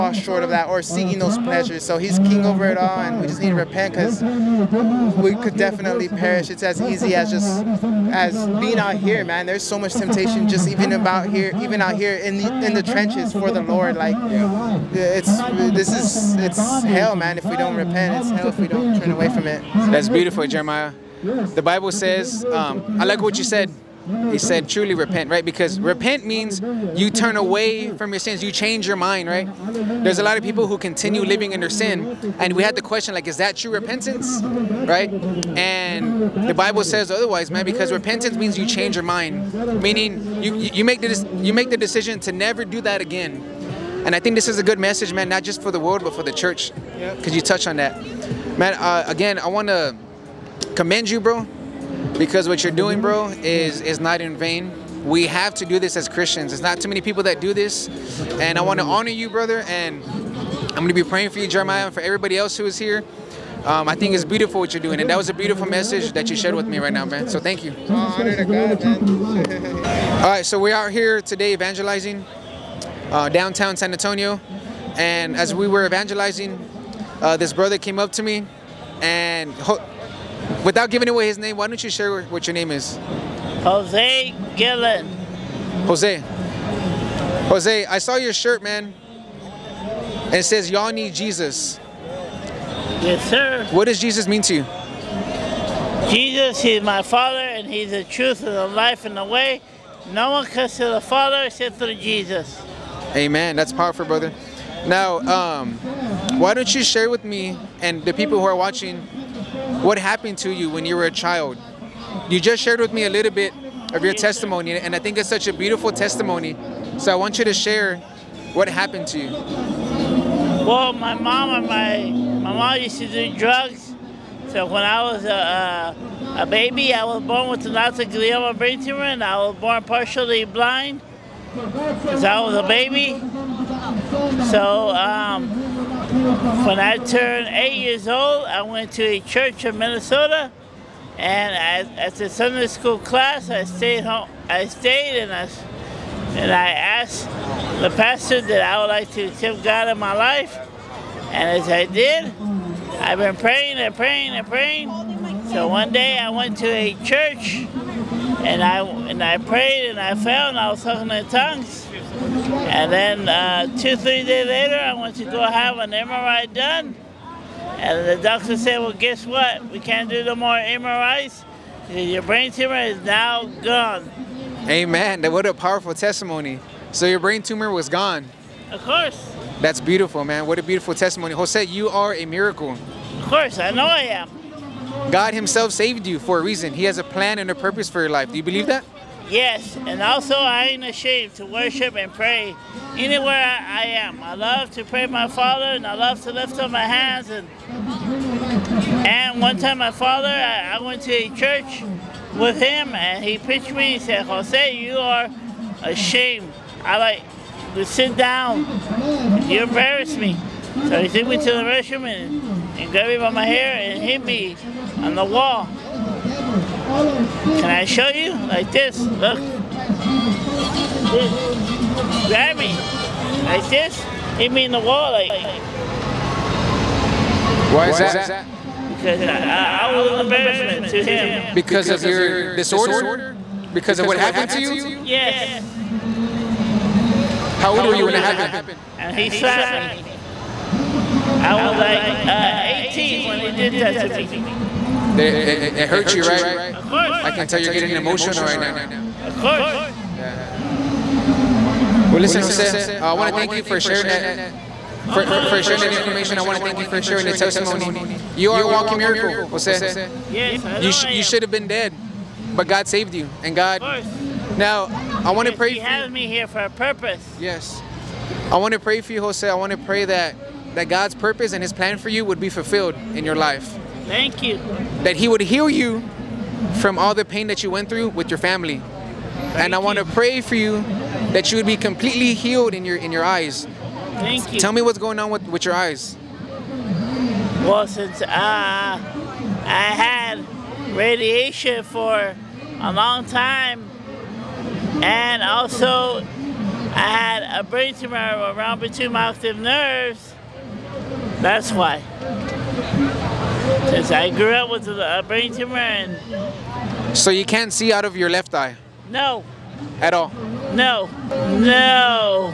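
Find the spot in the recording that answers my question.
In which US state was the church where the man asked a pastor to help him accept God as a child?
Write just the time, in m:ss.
2:19.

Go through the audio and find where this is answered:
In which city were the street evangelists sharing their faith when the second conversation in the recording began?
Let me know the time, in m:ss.
1:13.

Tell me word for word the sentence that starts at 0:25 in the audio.
Because repent means you turn away from your sins, you change your mind, right?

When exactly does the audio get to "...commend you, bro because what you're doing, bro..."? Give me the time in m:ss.
0:50.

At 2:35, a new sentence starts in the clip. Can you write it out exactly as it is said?
So one day I went to a church and I and I prayed and I found I was talking in tongues.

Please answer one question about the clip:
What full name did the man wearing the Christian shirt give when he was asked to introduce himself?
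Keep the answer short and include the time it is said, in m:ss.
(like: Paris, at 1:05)
Jose Gillen, at 1:23.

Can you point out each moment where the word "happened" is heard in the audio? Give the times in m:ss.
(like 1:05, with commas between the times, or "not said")
1:49, 1:58, 3:54, 3:58.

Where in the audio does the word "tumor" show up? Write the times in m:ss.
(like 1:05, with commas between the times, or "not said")
2:08, 2:52, 2:57, 4:57, 5:05.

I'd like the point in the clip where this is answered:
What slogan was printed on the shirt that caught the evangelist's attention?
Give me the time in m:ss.
1:30.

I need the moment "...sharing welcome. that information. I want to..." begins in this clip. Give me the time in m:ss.
4:15.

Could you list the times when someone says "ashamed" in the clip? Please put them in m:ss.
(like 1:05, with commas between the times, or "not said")
3:10, 3:25.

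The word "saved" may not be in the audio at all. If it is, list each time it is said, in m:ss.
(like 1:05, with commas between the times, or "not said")
3:05, 4:22.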